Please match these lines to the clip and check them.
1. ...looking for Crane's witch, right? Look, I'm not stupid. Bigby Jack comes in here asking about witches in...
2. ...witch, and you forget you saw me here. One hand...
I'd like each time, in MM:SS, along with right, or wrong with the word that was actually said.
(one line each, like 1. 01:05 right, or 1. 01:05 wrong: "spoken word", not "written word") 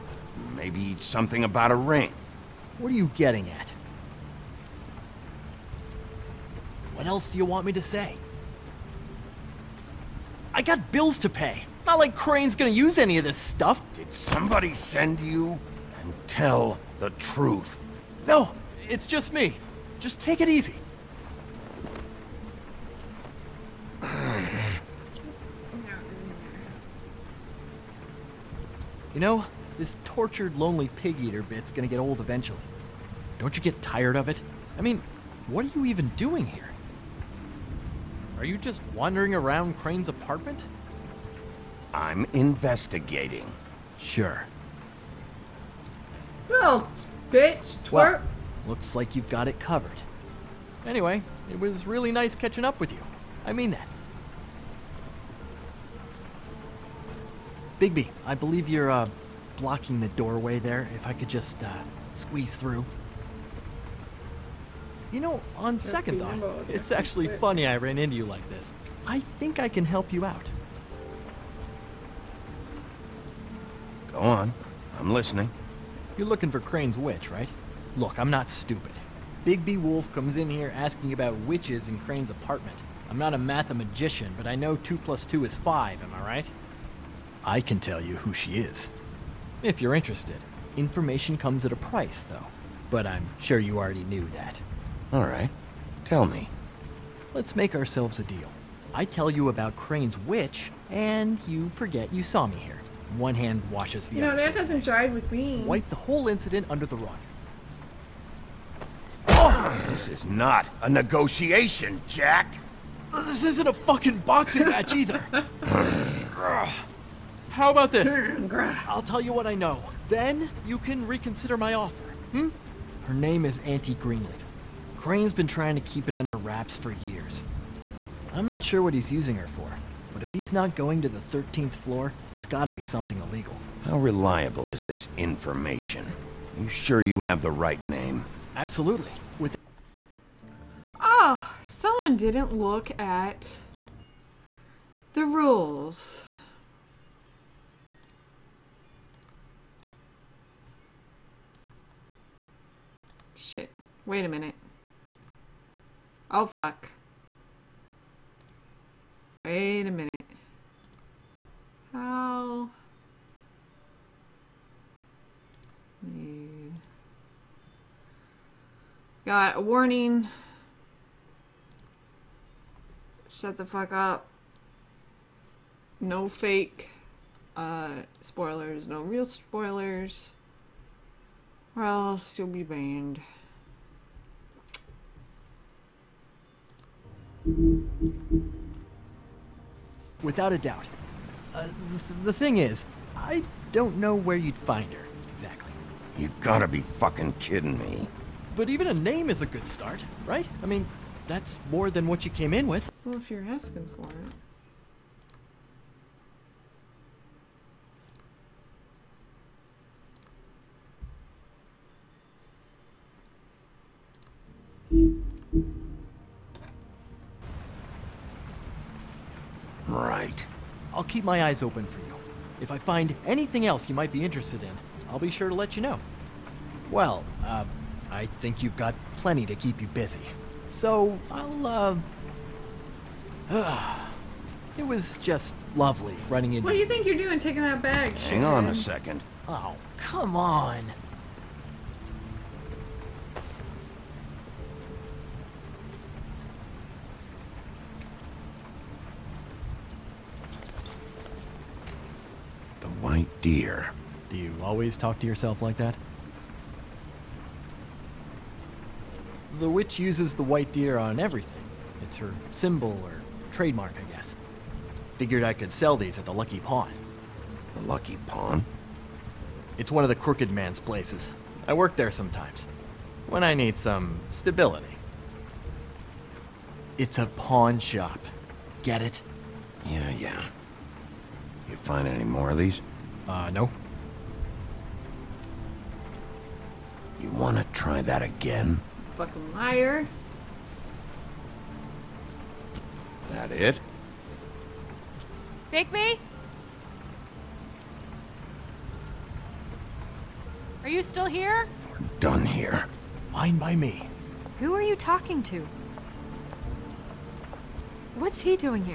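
1. 01:16 wrong: "Wolf", not "Jack"
2. 01:40 right.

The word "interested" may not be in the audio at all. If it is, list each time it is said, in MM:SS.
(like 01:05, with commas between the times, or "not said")
01:29, 03:44.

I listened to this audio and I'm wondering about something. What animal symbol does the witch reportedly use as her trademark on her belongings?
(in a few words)
white deer.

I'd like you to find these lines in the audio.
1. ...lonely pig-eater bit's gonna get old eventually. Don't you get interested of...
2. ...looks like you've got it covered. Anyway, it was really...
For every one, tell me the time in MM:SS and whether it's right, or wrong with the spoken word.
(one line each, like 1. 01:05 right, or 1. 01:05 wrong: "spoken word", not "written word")
1. 00:30 wrong: "tired", not "interested"
2. 00:48 right.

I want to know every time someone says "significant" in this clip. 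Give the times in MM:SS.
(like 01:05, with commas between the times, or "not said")
not said.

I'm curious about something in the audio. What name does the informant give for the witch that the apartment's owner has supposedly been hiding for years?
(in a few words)
Auntie Greenleaf.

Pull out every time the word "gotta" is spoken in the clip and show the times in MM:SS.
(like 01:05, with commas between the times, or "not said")
02:12, 03:16.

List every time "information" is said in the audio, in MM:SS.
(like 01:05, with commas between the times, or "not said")
01:30, 02:15.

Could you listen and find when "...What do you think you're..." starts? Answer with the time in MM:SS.
03:56.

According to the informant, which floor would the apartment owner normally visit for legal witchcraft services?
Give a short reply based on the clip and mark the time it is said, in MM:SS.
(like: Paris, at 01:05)
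13th floor, at 02:11.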